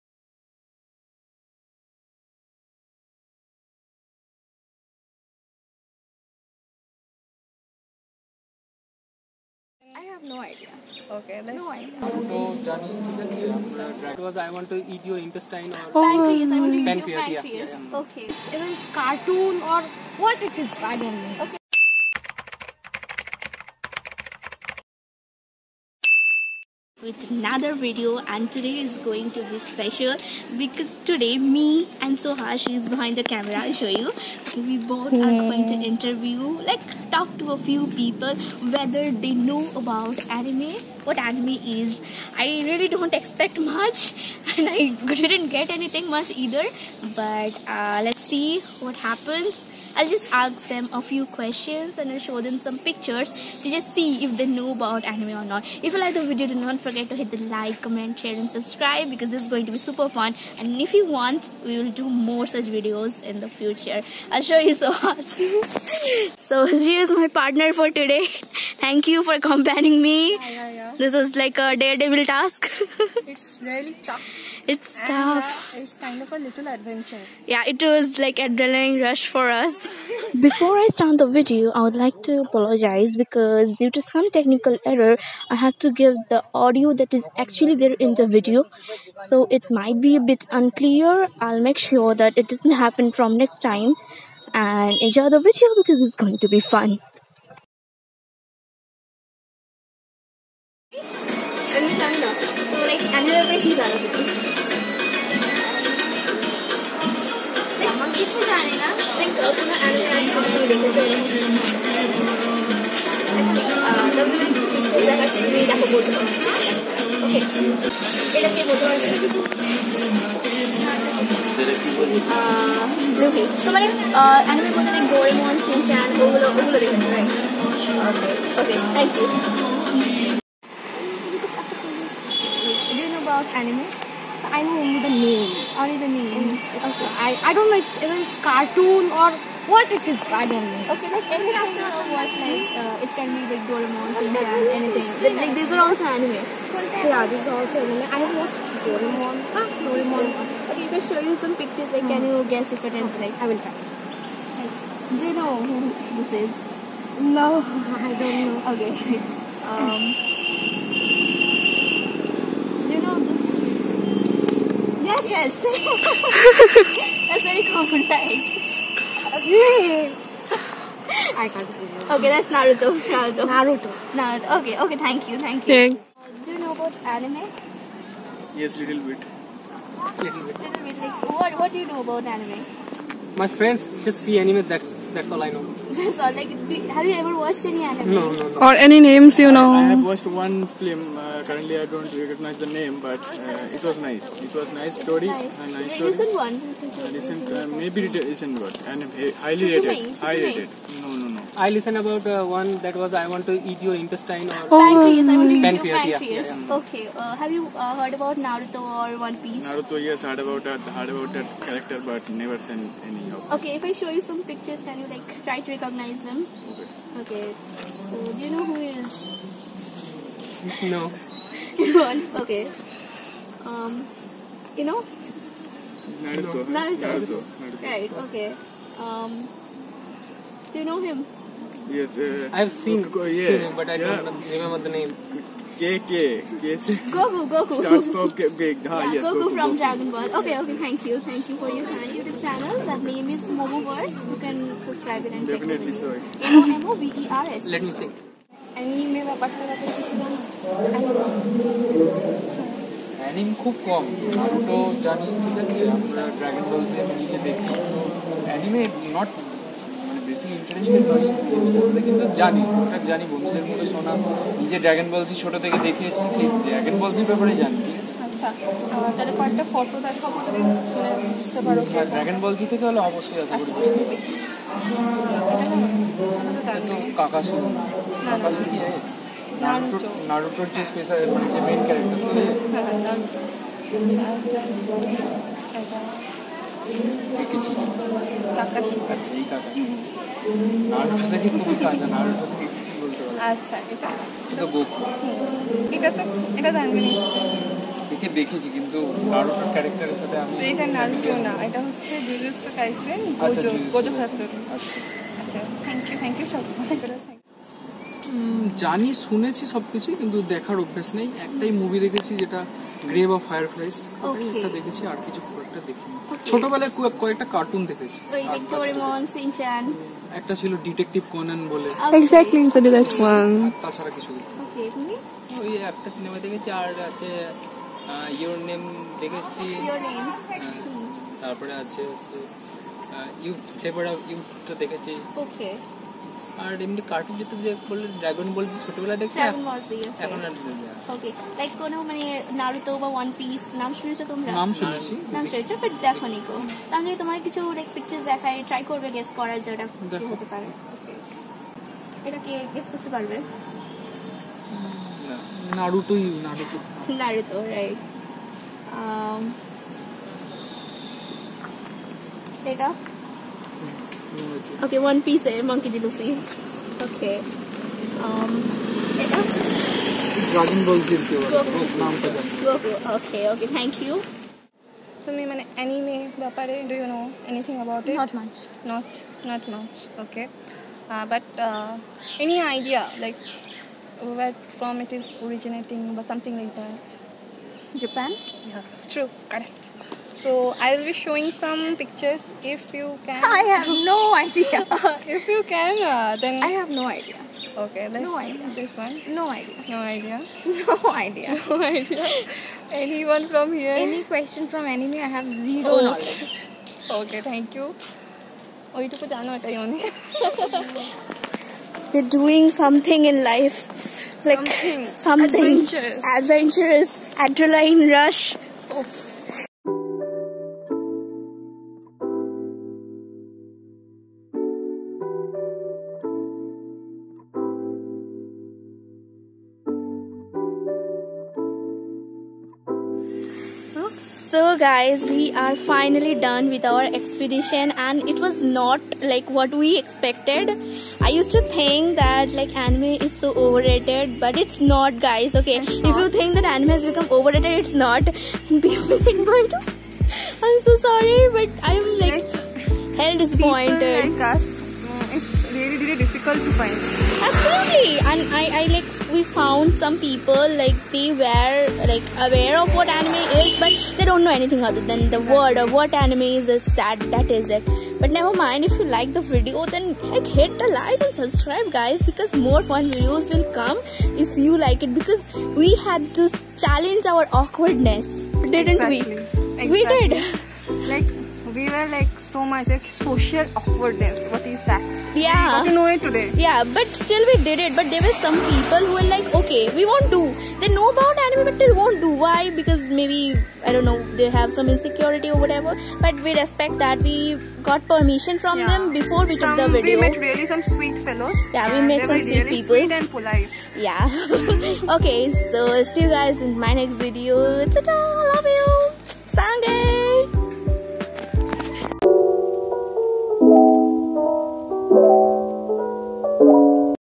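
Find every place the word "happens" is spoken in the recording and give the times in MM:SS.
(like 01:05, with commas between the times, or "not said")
00:48, 01:32.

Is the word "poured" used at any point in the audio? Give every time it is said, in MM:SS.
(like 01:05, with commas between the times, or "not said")
not said.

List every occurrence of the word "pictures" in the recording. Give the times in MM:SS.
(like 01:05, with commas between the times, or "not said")
00:52, 02:31, 03:34, 06:31.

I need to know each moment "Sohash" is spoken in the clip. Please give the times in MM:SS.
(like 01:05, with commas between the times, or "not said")
00:32.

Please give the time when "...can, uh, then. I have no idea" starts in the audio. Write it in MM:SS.
06:35.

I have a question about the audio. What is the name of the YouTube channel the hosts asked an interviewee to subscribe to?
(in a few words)
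Momoverse.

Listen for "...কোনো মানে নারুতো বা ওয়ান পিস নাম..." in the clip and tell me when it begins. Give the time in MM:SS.
05:41.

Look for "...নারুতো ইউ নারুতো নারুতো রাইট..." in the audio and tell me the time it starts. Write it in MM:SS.
05:55.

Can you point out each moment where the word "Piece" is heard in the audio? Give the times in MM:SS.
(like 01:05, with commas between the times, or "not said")
03:29, 06:05.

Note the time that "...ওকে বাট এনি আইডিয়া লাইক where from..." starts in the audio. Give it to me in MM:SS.
06:20.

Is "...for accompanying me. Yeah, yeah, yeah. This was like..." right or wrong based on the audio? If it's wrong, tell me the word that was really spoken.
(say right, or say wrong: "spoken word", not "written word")
right.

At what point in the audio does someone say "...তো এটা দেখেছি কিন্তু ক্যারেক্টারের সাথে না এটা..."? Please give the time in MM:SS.
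04:56.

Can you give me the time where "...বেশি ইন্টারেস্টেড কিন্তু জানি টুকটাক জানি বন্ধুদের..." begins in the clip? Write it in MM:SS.
04:20.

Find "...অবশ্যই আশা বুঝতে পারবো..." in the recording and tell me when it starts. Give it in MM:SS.
04:33.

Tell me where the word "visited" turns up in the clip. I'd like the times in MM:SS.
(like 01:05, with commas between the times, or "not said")
not said.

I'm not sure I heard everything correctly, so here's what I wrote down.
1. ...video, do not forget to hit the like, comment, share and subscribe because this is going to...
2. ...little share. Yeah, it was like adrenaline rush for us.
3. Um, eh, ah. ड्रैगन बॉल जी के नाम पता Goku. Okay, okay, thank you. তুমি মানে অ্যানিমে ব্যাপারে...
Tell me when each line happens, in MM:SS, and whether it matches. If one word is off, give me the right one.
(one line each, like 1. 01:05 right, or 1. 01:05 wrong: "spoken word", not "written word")
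1. 00:56 right
2. 01:16 wrong: "adventure", not "share"
3. 06:08 right.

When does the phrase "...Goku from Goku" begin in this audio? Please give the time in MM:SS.
03:59.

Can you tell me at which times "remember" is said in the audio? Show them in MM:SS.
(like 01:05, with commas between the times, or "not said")
03:54.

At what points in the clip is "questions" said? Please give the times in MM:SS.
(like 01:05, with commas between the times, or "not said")
00:51, 06:44.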